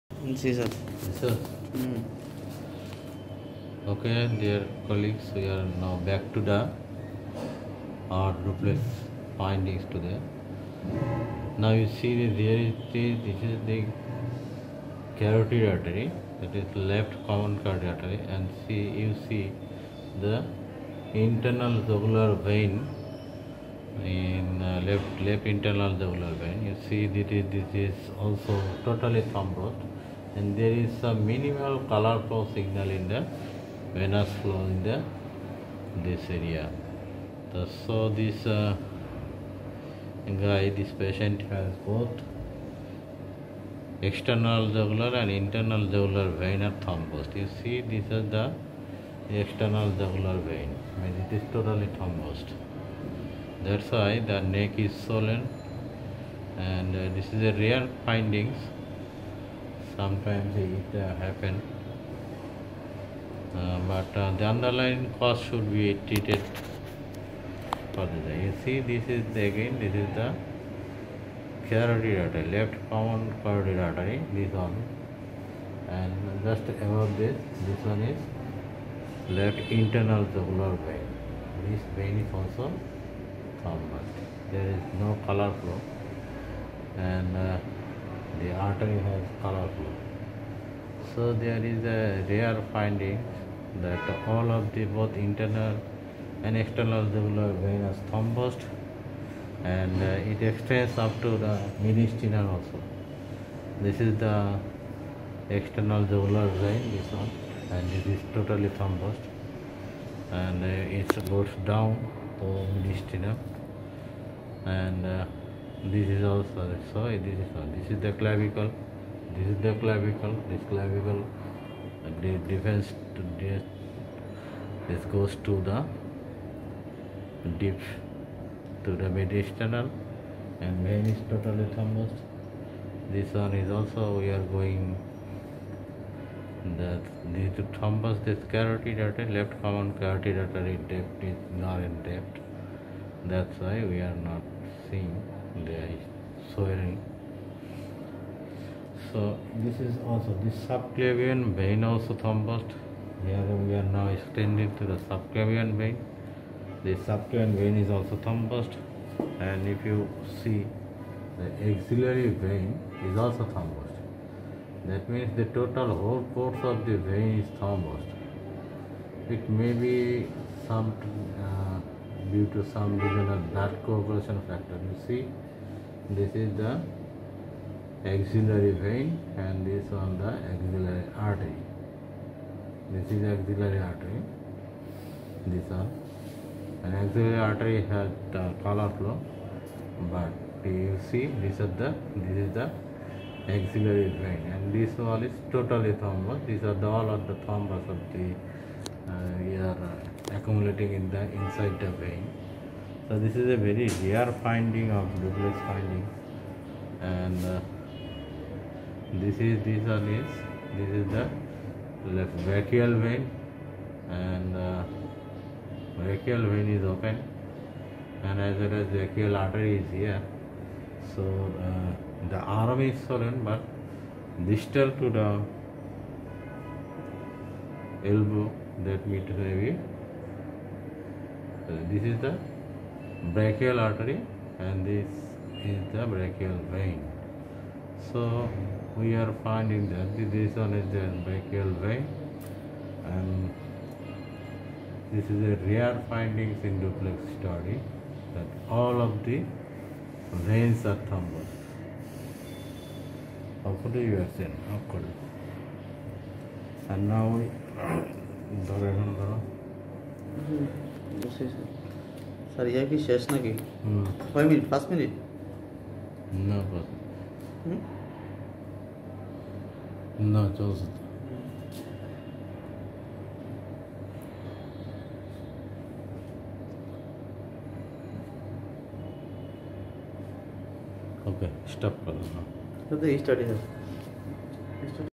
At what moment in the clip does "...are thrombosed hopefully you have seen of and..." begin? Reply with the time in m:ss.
4:10.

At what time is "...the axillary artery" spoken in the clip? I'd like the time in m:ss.
3:00.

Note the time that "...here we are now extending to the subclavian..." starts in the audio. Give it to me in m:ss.
2:33.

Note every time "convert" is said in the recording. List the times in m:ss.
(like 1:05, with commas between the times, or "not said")
1:23.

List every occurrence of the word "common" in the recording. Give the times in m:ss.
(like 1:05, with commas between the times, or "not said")
0:17, 1:12, 2:19.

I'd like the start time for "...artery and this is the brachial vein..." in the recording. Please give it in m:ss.
3:53.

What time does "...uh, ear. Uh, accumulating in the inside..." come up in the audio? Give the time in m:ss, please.
3:19.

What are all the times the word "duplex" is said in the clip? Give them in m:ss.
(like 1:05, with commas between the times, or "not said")
0:08, 3:25, 4:06.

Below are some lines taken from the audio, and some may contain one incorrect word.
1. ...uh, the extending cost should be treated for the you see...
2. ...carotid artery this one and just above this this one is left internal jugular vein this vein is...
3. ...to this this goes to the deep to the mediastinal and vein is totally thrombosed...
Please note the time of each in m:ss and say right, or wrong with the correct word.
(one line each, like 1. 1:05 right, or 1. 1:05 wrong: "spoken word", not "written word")
1. 1:04 wrong: "underlying", not "extending"
2. 1:13 right
3. 2:03 right.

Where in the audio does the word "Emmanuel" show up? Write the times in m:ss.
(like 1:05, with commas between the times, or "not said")
not said.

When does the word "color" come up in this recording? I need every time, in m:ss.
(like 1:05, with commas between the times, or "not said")
0:31, 1:25, 1:29, 3:08.